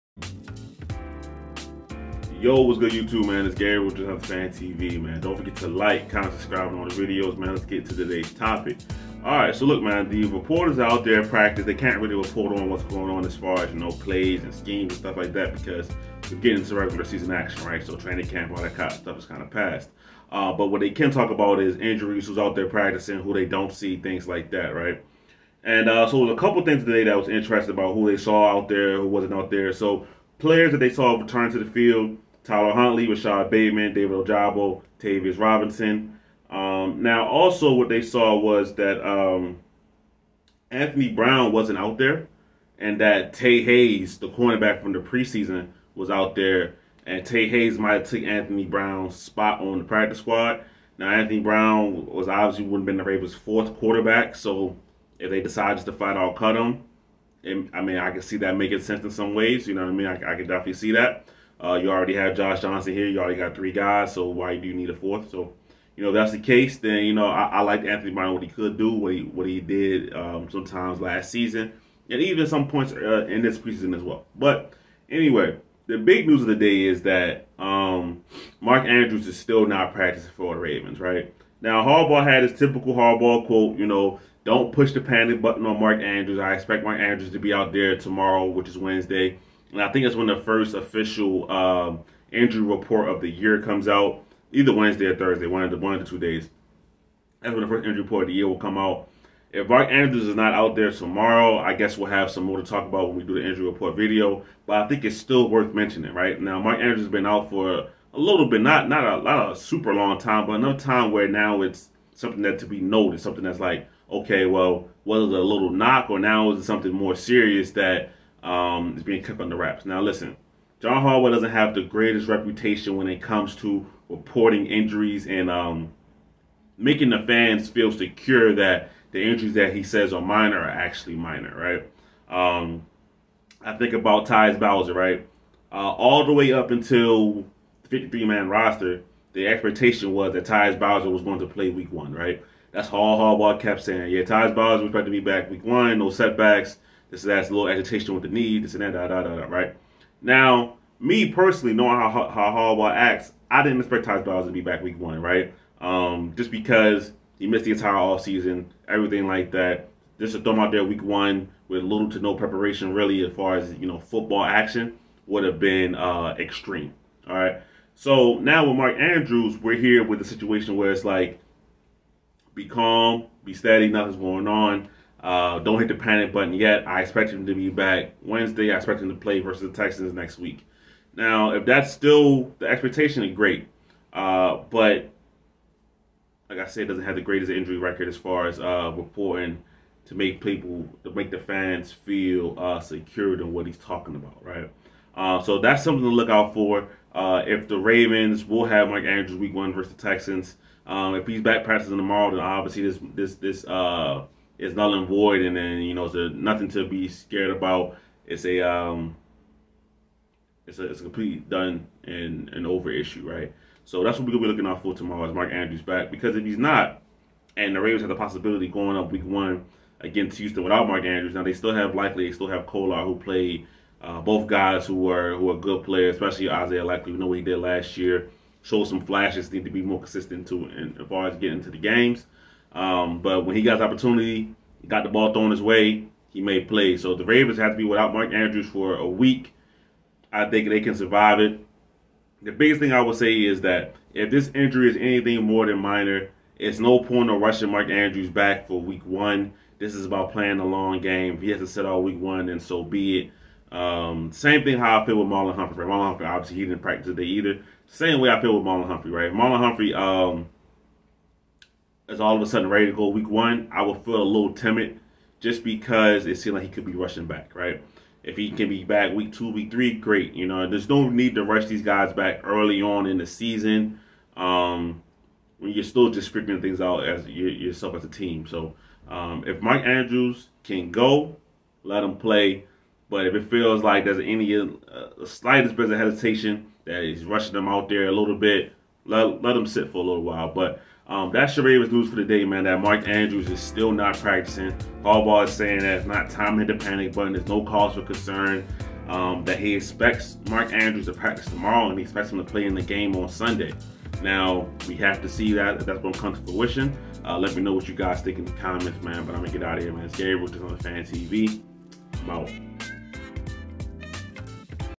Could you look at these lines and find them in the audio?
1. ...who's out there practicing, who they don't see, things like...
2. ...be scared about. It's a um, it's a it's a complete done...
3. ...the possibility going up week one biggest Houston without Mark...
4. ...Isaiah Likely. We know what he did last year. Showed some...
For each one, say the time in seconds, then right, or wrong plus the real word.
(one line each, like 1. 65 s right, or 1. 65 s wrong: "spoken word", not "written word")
1. 22 s right
2. 206 s right
3. 218 s wrong: "against", not "biggest"
4. 226 s right.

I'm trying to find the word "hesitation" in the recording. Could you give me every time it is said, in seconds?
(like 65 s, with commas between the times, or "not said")
285 s.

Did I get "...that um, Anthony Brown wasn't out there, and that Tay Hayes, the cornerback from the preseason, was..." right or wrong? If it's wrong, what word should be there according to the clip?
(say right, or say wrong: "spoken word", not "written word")
right.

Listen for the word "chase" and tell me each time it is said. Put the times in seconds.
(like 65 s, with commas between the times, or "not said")
not said.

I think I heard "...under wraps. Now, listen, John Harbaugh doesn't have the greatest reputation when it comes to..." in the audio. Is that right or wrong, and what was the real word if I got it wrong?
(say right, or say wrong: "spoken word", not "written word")
right.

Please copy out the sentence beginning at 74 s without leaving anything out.
But anyway, the big news of the day is that um, Mark Andrews is still not practicing for the Ravens, right?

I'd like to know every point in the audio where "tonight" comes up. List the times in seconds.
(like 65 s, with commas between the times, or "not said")
not said.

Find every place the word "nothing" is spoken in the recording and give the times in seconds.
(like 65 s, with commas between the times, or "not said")
173 s, 206 s.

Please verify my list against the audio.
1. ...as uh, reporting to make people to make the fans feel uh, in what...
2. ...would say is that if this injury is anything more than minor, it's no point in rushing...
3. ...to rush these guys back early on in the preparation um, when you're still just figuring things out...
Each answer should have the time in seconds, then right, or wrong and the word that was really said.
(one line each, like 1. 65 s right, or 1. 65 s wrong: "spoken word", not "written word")
1. 188 s right
2. 243 s right
3. 271 s wrong: "season", not "preparation".